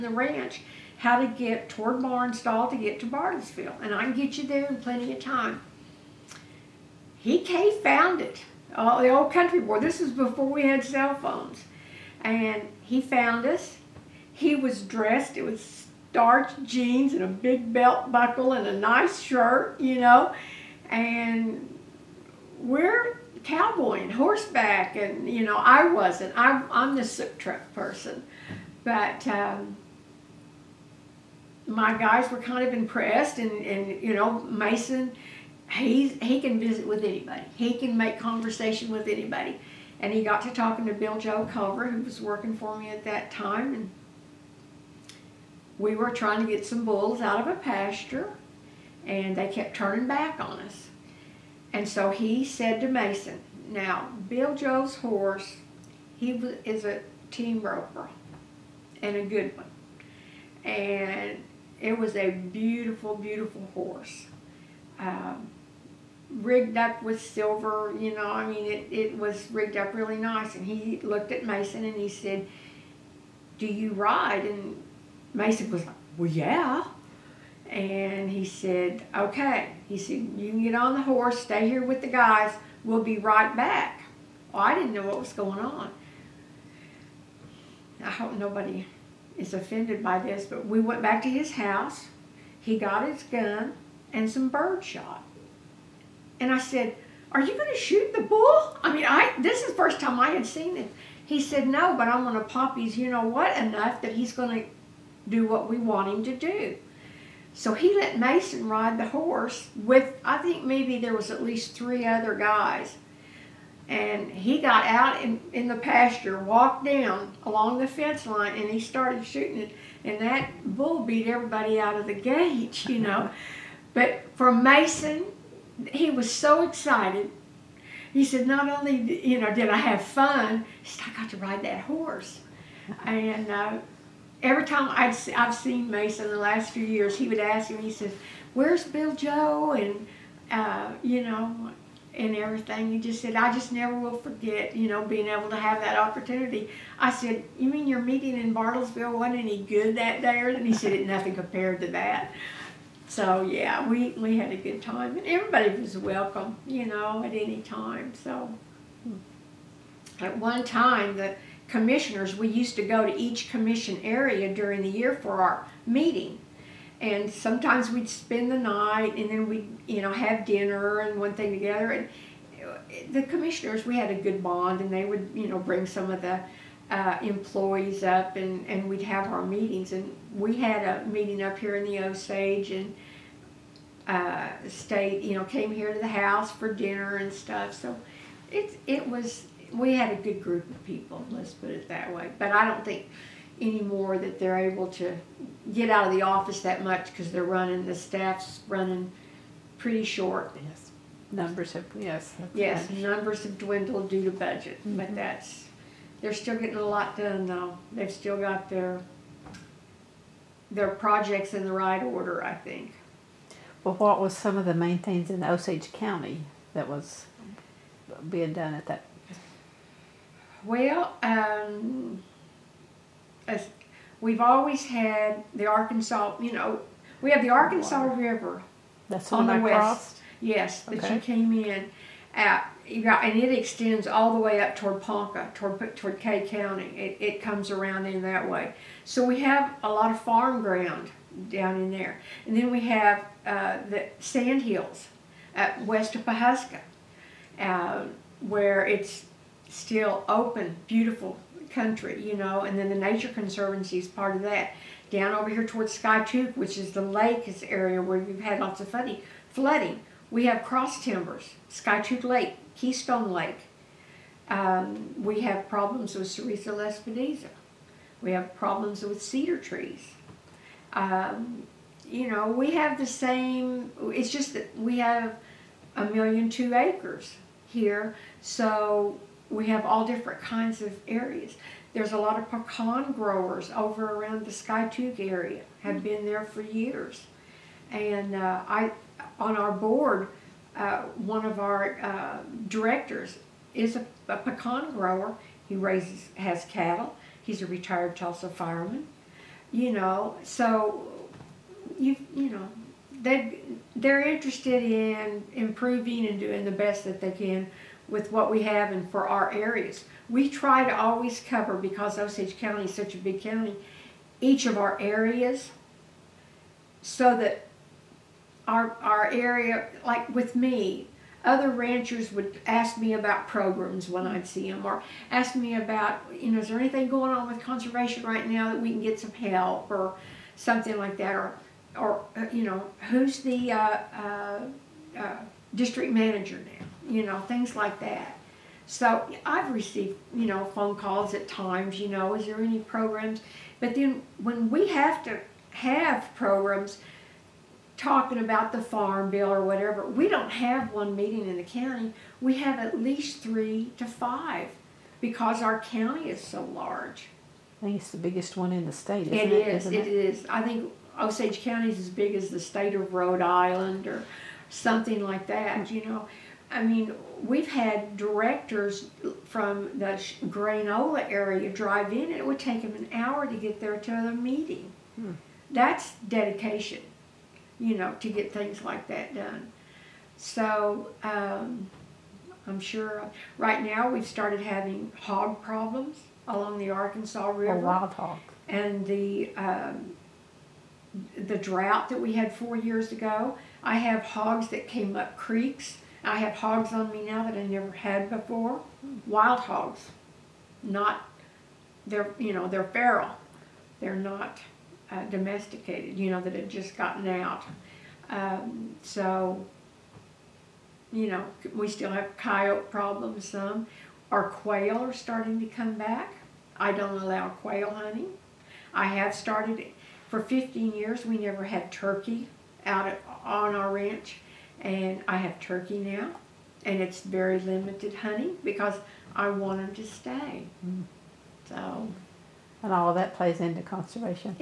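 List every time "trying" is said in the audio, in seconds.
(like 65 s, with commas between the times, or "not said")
46 s.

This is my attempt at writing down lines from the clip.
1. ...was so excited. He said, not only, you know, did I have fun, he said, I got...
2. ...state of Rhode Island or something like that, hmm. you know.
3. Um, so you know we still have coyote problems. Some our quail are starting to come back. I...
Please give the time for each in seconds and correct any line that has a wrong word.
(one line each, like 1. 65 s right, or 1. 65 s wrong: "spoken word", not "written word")
1. 126 s right
2. 362 s right
3. 408 s right.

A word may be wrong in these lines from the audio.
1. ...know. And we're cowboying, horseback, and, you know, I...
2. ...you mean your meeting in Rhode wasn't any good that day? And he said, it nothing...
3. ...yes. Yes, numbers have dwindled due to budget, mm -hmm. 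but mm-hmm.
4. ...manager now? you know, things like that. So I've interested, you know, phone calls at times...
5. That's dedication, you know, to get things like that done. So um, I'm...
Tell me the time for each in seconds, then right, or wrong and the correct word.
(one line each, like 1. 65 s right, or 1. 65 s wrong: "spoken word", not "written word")
1. 19 s right
2. 147 s wrong: "Bartlesville", not "Rhode"
3. 201 s right
4. 336 s wrong: "received", not "interested"
5. 375 s right.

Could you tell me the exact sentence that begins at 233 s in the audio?
Got, and it extends all the way up toward Ponca, toward, toward Kay County.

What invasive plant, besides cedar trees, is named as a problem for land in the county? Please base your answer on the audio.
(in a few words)
Sericea lespedeza.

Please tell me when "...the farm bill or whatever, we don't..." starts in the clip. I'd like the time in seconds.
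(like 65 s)
348 s.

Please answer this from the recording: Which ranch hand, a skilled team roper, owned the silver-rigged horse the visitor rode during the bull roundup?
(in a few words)
Bill Joe Culver.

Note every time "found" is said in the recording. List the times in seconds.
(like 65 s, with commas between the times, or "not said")
7 s, 13 s.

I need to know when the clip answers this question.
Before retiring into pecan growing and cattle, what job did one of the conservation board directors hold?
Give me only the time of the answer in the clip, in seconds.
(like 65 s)
298 s.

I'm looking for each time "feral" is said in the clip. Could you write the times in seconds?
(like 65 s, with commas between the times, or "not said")
402 s.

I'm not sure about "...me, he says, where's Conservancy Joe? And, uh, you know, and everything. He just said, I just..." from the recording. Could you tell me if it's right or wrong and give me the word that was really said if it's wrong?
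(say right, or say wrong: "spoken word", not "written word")
wrong: "Bill", not "Conservancy".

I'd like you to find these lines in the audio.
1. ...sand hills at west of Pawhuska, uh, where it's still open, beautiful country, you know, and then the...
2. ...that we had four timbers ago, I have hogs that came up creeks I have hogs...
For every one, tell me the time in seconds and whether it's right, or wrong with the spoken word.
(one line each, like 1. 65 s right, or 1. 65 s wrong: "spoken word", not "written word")
1. 244 s right
2. 392 s wrong: "years", not "timbers".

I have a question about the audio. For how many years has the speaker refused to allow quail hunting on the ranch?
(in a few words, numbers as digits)
15.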